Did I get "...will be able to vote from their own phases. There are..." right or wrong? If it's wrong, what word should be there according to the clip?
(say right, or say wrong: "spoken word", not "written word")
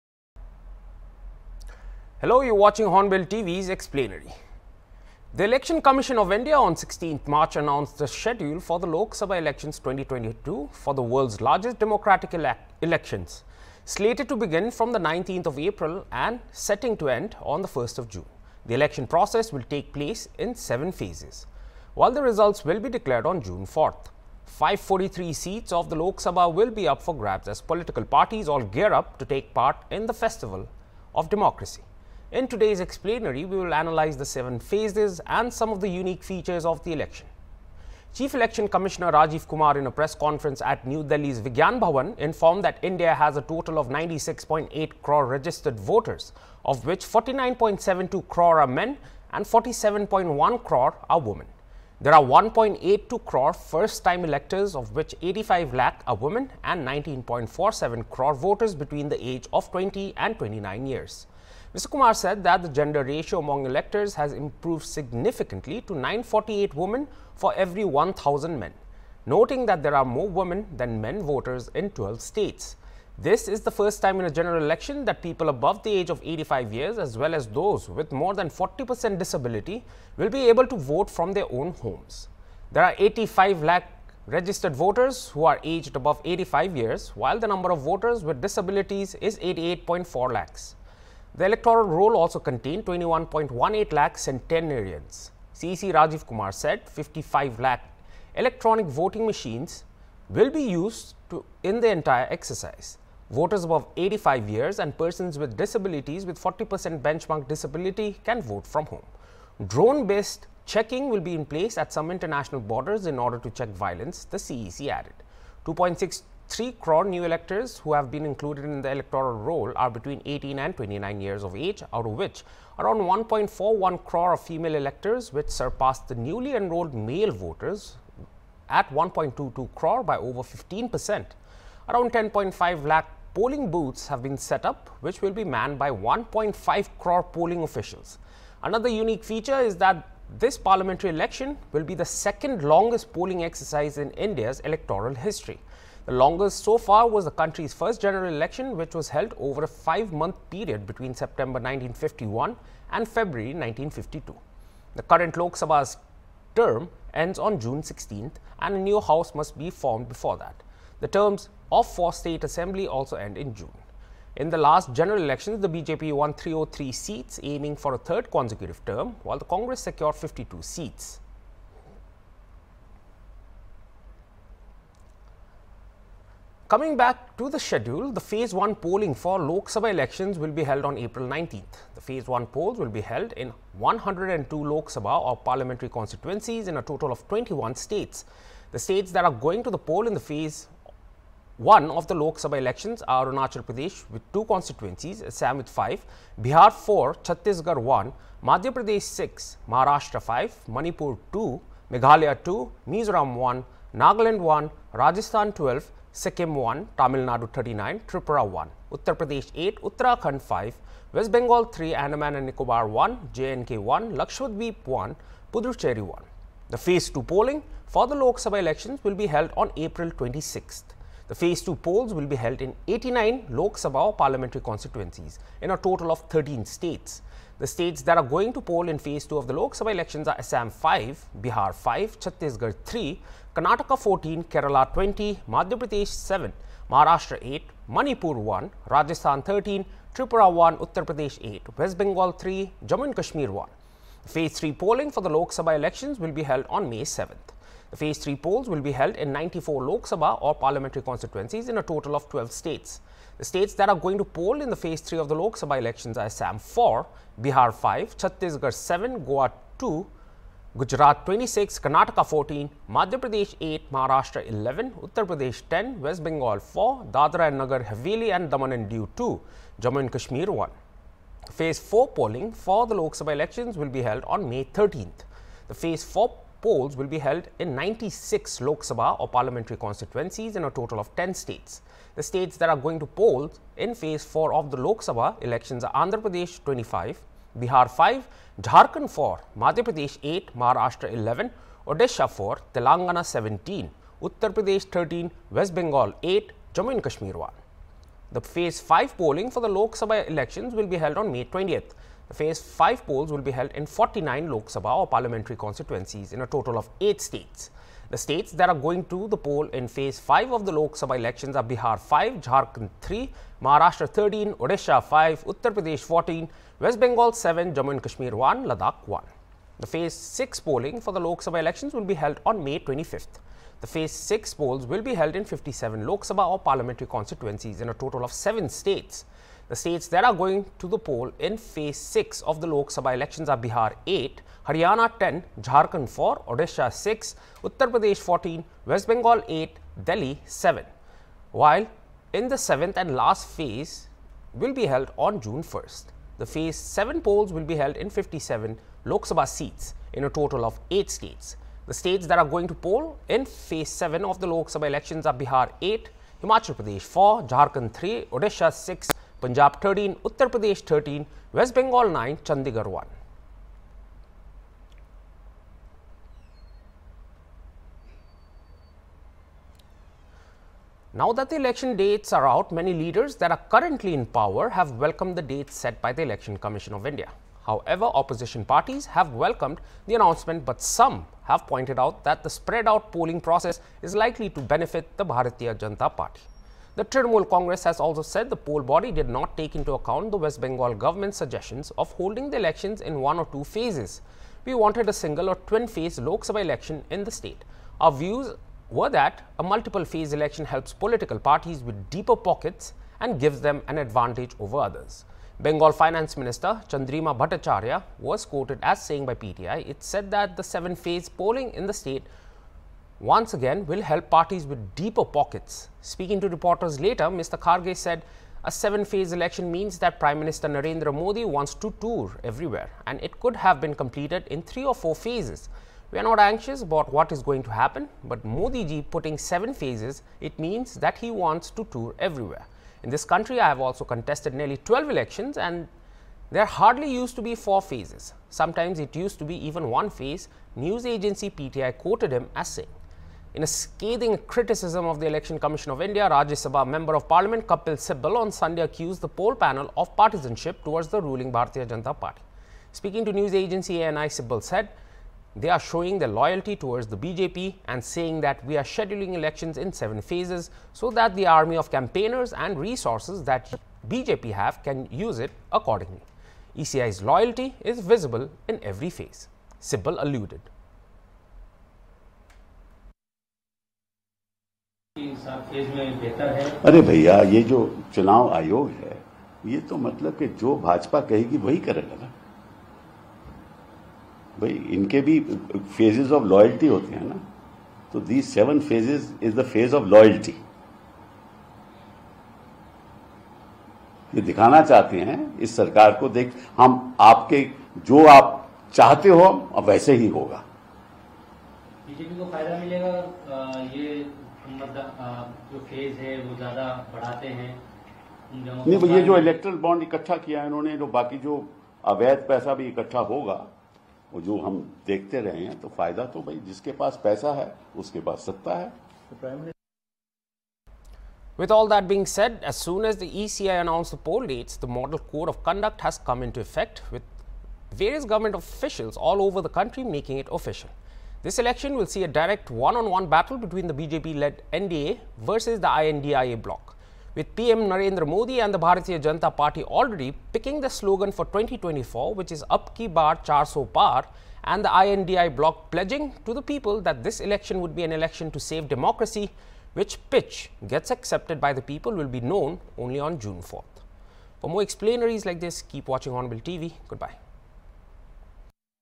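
wrong: "homes", not "phases".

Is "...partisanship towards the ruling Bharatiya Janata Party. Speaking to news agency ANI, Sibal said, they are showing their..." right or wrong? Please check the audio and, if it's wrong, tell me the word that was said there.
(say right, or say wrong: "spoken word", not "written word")
right.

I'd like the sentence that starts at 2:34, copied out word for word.
The current Lok Sabha's term ends on June 16th, and a new house must be formed before that.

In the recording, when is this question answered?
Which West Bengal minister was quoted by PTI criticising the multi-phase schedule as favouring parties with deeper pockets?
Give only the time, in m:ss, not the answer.
6:46.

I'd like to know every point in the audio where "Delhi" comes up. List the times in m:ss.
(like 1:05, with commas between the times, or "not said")
0:41, 5:40.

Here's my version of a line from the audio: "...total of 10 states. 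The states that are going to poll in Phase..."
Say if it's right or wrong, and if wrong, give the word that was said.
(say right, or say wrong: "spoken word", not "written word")
right.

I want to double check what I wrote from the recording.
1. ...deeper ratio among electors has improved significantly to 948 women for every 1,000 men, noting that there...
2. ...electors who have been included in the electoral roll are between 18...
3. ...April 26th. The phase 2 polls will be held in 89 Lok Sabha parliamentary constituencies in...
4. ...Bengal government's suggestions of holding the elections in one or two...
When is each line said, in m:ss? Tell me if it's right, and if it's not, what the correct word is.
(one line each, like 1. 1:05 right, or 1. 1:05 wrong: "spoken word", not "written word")
1. 1:02 wrong: "gender", not "deeper"
2. 1:57 right
3. 3:39 right
4. 6:30 right.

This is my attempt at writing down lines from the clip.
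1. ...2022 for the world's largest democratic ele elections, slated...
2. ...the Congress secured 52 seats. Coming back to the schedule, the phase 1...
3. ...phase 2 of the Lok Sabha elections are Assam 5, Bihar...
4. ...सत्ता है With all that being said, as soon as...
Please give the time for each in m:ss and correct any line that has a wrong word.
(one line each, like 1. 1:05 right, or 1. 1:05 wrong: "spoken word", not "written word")
1. 0:09 right
2. 2:49 right
3. 3:48 right
4. 8:38 right.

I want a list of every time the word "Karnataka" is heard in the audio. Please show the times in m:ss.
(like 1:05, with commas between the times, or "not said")
3:53, 4:21.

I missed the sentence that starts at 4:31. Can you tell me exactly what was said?
Phase 4 polling for the Lok Sabha elections will be held on May 13th.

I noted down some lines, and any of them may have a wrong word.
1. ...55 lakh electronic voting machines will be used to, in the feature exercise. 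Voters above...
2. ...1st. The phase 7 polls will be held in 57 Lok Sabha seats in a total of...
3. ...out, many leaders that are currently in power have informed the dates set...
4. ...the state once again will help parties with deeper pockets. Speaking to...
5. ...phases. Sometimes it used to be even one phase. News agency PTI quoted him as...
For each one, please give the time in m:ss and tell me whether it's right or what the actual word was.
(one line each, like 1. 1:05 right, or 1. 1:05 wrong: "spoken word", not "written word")
1. 1:36 wrong: "entire", not "feature"
2. 5:45 right
3. 6:12 wrong: "welcomed", not "informed"
4. 6:51 right
5. 7:17 right.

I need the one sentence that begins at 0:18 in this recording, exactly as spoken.
The election process will take place in seven phases, while the results will be declared on June 4th.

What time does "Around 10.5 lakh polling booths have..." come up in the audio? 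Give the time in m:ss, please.
2:11.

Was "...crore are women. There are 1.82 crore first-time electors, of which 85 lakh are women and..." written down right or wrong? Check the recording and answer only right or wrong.
right.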